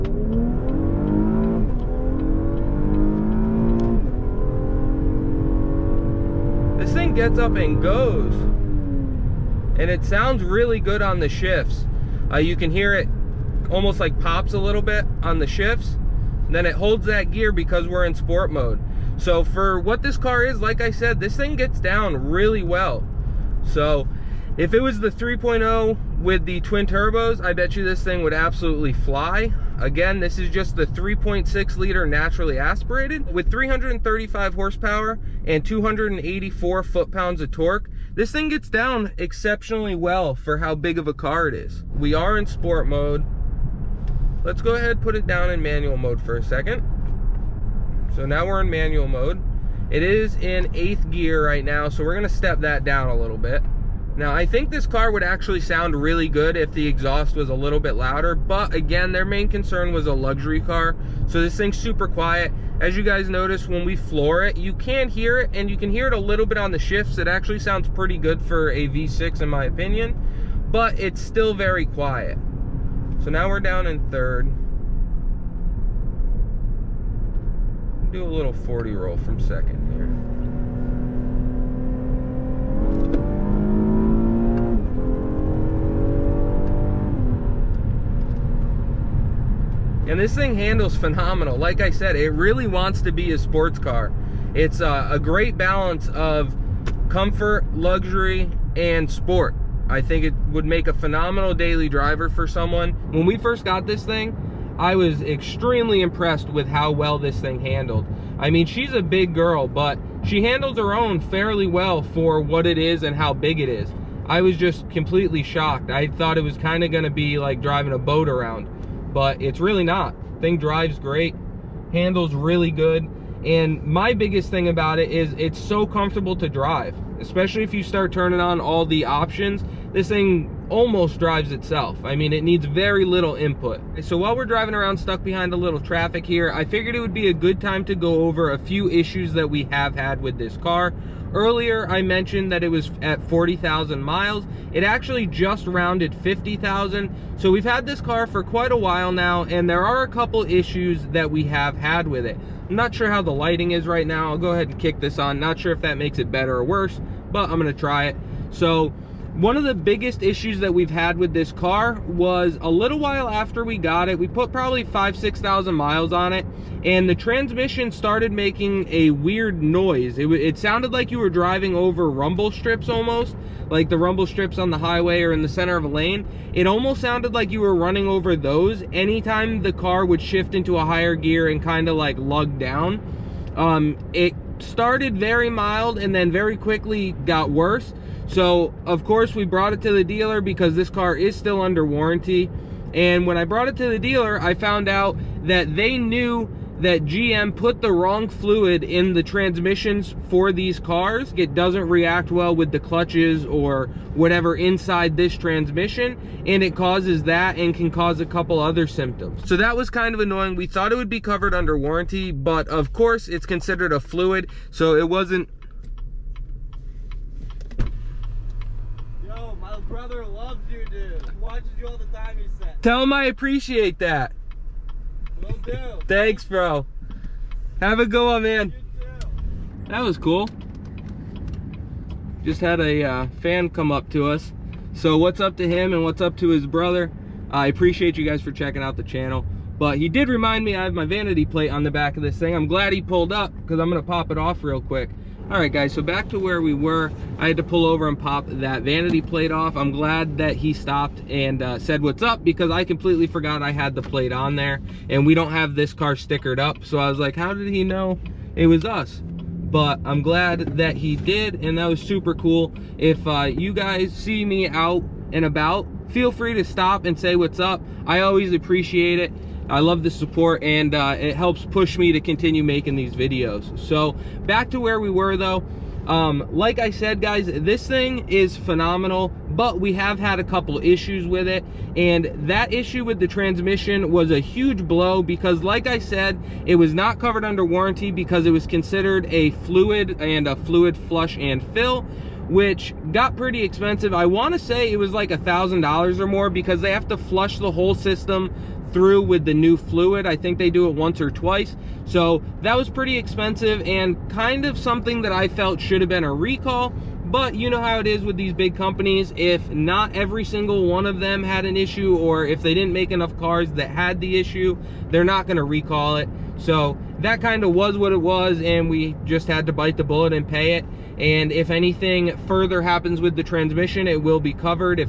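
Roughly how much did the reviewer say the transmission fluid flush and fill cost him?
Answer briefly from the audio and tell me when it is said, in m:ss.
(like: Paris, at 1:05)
$1,000, at 4:55.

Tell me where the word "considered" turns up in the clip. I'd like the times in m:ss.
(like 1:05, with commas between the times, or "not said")
3:33, 4:48.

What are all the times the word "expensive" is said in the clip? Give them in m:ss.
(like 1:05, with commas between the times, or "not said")
4:53, 5:03.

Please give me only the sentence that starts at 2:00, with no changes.
Thing drives great, handles really good.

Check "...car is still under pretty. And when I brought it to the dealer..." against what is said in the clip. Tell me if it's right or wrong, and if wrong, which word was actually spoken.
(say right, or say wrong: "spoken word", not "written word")
wrong: "warranty", not "pretty".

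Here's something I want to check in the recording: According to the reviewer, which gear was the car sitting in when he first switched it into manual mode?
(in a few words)
eighth gear.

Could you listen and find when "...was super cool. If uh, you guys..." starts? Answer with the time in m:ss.
4:21.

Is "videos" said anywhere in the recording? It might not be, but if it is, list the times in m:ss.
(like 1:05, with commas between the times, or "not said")
4:33.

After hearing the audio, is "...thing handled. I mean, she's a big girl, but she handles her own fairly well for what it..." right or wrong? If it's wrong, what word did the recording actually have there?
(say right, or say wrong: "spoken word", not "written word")
right.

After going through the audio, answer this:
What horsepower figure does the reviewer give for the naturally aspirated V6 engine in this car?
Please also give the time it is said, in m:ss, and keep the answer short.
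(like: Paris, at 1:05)
335, at 0:33.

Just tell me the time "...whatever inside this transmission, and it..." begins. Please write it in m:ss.
3:24.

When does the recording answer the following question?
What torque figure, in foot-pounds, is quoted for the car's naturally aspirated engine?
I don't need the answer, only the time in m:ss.
0:35.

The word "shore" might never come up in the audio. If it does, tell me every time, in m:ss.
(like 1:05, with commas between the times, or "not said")
not said.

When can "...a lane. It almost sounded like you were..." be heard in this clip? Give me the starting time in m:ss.
2:55.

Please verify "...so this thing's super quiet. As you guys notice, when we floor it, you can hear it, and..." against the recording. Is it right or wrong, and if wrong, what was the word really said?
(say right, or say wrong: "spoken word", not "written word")
right.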